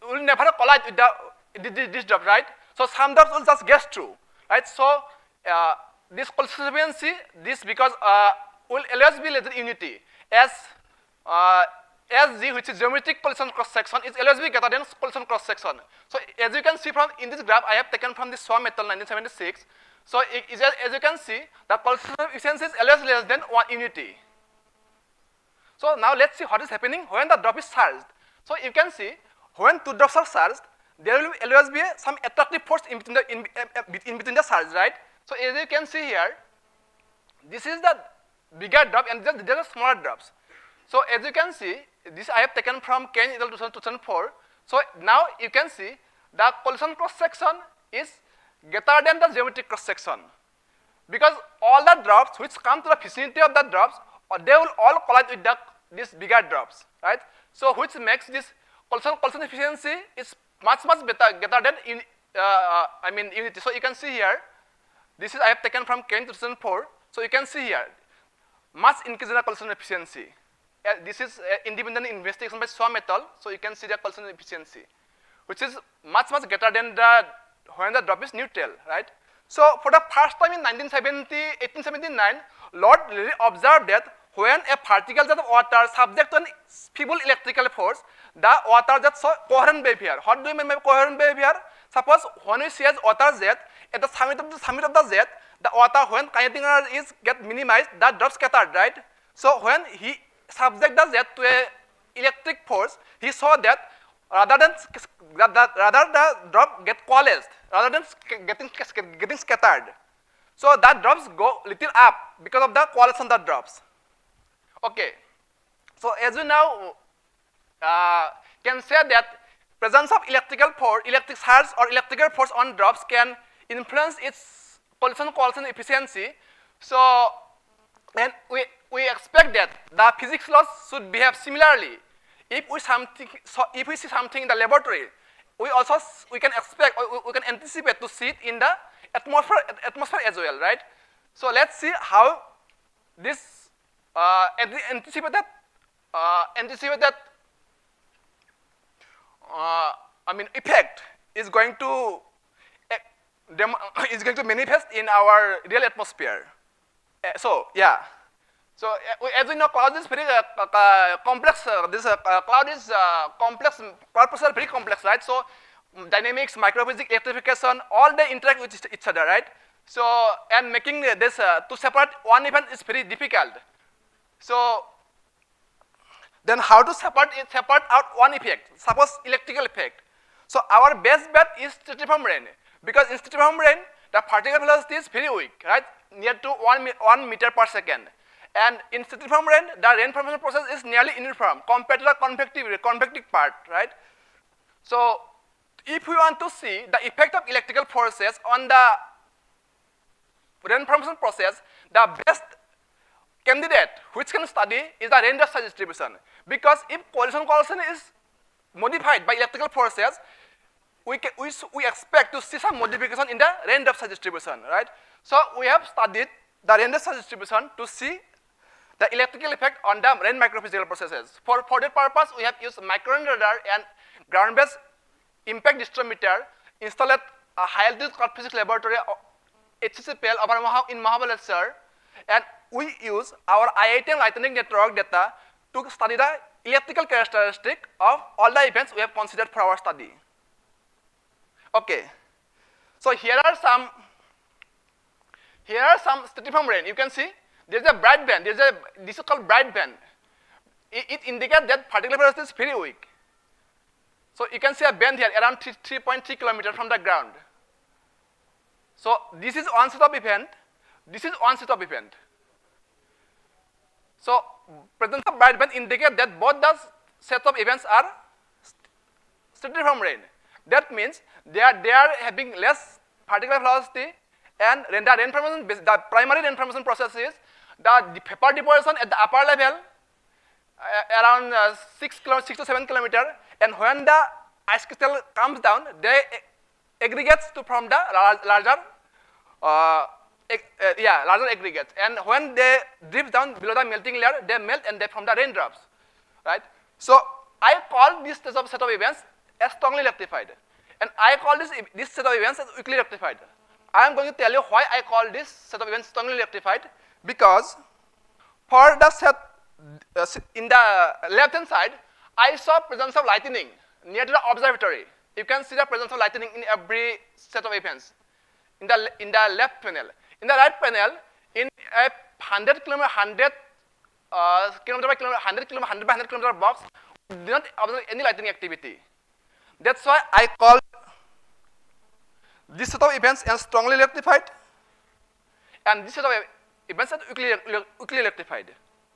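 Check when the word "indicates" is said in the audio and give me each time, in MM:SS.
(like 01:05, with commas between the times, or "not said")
04:11, 04:25.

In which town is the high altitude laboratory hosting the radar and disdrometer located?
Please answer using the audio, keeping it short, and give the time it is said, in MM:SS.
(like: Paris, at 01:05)
Mahabaleshwar, at 03:51.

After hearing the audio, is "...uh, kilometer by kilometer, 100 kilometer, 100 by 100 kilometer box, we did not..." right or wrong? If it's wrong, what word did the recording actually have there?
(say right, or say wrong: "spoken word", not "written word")
right.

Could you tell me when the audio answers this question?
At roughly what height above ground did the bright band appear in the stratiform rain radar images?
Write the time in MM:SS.
04:15.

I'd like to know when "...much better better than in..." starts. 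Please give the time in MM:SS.
01:00.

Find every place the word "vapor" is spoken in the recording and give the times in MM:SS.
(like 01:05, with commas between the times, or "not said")
04:38.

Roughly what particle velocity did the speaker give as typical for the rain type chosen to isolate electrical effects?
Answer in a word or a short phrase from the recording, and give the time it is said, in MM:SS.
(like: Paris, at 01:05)
1 meter per second, at 03:06.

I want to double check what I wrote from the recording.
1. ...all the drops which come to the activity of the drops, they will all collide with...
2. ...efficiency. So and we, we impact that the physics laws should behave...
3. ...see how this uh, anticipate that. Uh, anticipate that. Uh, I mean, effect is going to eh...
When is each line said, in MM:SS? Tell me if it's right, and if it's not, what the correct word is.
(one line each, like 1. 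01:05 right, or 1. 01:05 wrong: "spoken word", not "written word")
1. 00:51 wrong: "vicinity", not "activity"
2. 02:05 wrong: "expect", not "impact"
3. 02:21 right.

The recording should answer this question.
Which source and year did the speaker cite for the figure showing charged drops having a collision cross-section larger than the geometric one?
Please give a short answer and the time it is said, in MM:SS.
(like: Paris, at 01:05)
Khain 2004, at 00:43.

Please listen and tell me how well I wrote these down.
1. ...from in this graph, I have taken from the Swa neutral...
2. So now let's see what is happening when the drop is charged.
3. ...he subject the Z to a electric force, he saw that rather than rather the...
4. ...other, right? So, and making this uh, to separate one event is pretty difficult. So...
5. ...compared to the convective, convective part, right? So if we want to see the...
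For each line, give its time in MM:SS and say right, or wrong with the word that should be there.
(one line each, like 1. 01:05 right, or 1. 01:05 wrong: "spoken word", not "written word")
1. 00:16 wrong: "metal", not "neutral"
2. 00:25 right
3. 01:39 right
4. 02:49 right
5. 03:11 right.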